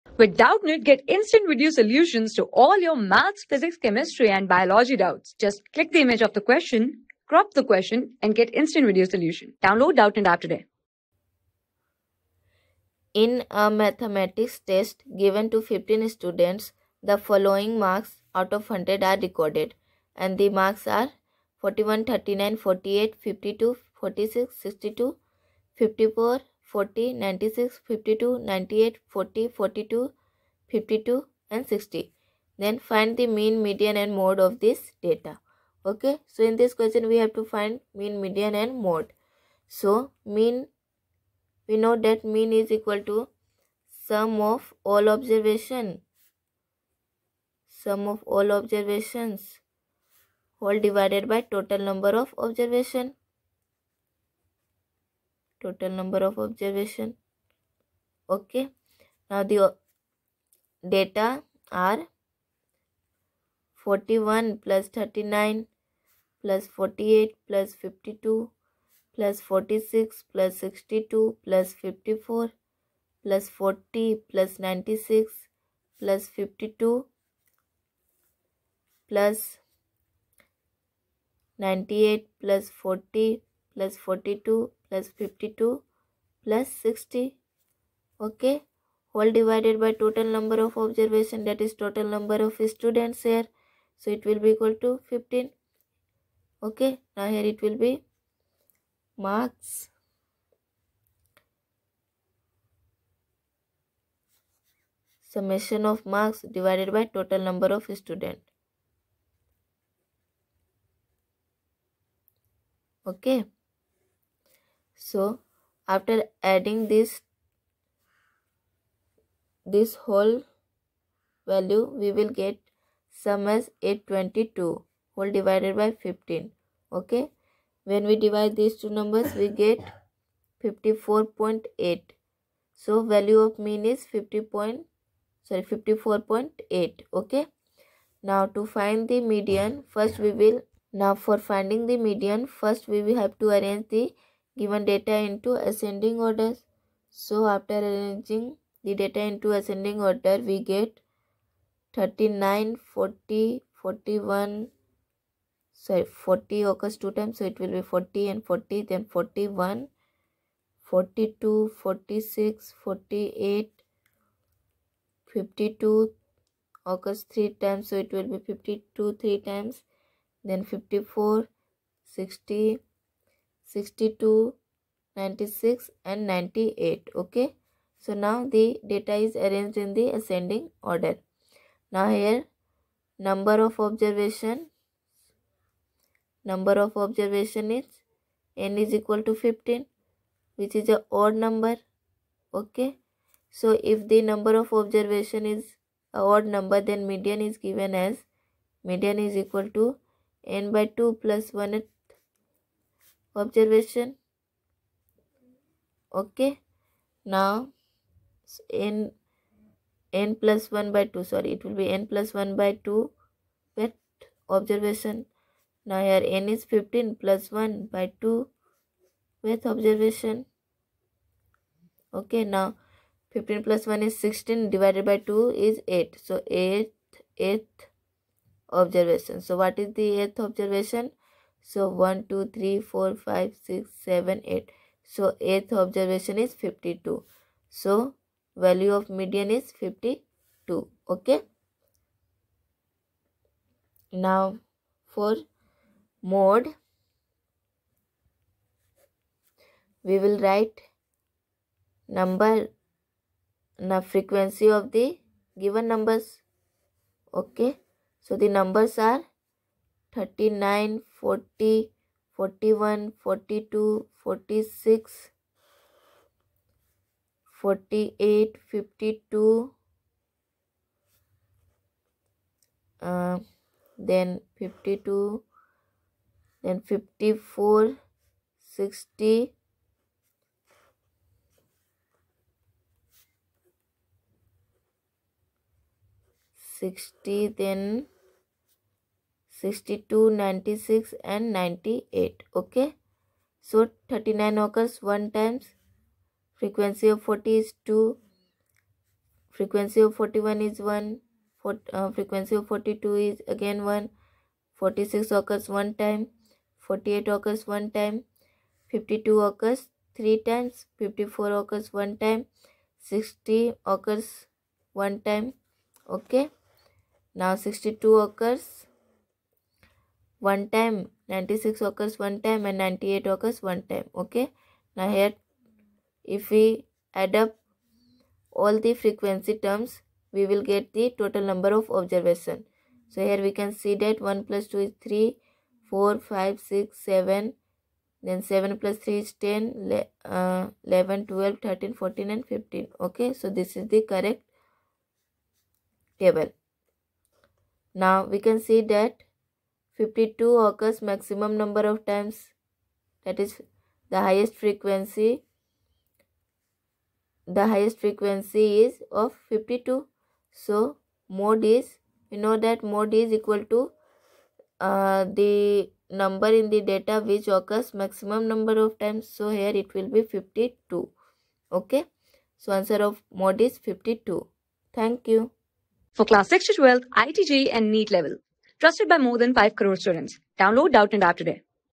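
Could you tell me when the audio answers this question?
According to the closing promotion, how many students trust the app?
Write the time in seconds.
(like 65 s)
379 s.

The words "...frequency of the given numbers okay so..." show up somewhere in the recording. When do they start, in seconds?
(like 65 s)
254 s.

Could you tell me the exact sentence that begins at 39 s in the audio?
So mean, we know that mean is equal to sum of all observation.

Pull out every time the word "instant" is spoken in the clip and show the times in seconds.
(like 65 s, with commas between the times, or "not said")
1 s, 8 s.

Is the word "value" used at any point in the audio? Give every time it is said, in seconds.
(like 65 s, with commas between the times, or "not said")
121 s, 133 s, 238 s.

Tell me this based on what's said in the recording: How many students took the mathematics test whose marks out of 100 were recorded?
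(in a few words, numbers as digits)
15.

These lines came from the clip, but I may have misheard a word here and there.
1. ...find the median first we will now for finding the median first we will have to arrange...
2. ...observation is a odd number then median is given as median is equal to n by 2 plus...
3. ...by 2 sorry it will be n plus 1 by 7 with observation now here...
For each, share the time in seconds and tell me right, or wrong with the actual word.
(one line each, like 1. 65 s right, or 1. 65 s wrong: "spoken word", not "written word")
1. 138 s right
2. 194 s right
3. 210 s wrong: "2", not "7".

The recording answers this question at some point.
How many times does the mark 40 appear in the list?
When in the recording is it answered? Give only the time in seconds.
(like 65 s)
296 s.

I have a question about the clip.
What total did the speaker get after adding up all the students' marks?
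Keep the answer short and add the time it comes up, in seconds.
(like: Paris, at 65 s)
822, at 123 s.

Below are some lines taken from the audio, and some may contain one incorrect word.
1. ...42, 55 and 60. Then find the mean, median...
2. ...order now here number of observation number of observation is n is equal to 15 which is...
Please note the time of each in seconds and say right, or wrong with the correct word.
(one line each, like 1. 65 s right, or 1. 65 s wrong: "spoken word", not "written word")
1. 29 s wrong: "52", not "55"
2. 180 s right.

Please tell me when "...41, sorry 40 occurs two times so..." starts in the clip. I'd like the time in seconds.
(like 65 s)
153 s.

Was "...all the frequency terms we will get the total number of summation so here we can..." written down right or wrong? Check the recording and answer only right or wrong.
wrong.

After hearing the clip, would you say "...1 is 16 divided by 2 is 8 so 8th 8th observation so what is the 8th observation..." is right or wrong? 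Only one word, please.
right.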